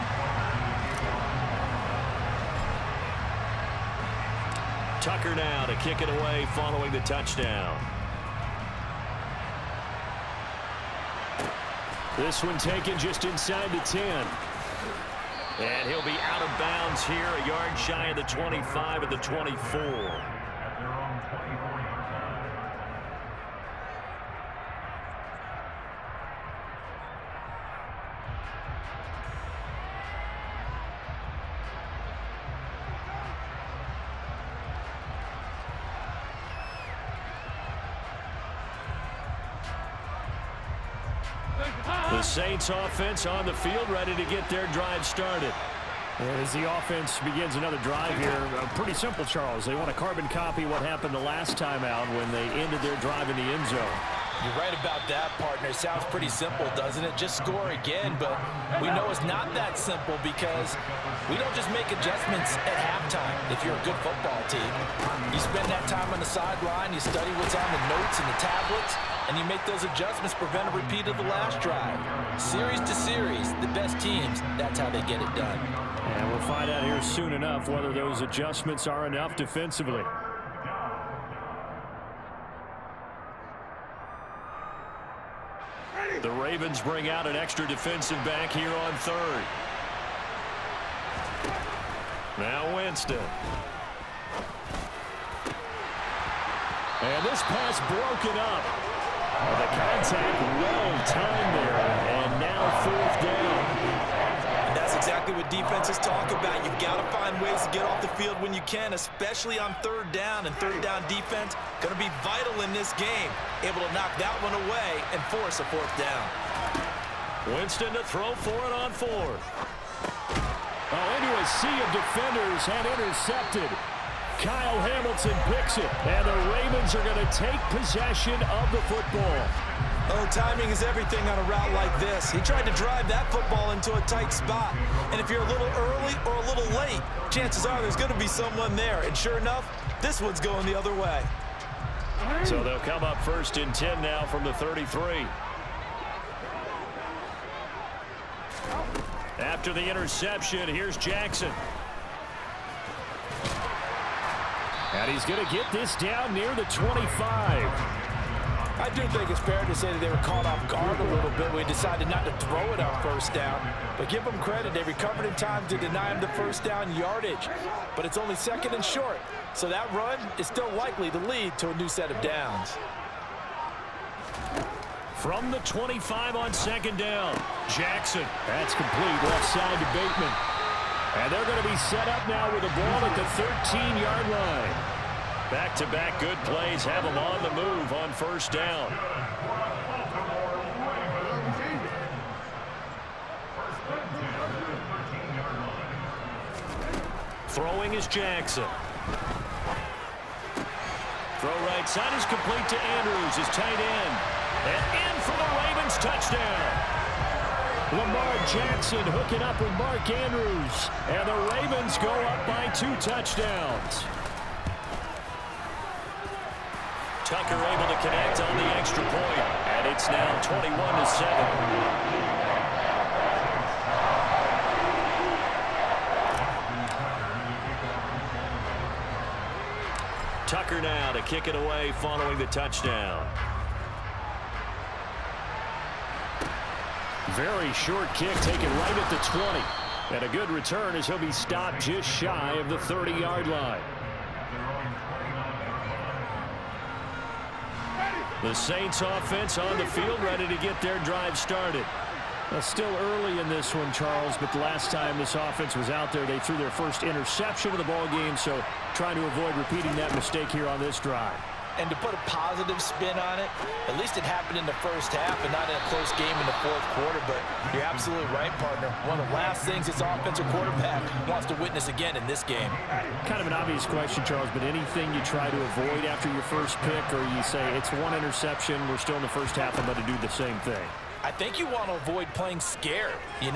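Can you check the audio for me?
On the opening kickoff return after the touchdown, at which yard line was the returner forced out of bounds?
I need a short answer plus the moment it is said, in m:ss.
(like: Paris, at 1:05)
24, at 0:19.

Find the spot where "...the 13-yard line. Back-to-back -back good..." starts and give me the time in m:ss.
3:03.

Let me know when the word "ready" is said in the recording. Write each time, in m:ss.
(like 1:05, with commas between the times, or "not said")
0:43, 4:10.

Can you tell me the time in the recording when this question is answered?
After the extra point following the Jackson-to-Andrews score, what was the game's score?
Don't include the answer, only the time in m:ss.
3:40.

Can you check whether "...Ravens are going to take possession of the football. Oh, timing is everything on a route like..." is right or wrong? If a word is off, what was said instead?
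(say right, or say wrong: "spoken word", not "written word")
right.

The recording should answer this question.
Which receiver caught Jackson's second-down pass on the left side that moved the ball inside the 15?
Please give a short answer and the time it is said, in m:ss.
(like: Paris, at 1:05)
Bateman, at 2:59.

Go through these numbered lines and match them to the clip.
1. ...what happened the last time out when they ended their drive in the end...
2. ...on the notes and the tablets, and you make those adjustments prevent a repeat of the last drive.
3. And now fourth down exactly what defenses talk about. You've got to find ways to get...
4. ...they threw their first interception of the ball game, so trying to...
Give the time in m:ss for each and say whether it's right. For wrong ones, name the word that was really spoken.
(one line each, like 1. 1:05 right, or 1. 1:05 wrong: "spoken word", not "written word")
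1. 0:50 right
2. 1:07 right
3. 1:42 right
4. 4:16 right.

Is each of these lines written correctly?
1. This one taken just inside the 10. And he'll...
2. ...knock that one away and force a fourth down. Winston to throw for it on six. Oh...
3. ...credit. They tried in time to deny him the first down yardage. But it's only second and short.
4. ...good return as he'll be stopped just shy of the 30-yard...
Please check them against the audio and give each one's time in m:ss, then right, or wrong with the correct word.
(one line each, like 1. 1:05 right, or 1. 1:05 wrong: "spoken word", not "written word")
1. 0:12 right
2. 1:53 wrong: "four", not "six"
3. 2:44 wrong: "recovered", not "tried"
4. 4:00 right.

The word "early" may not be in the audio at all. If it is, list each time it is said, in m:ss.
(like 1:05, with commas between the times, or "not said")
2:15, 4:12.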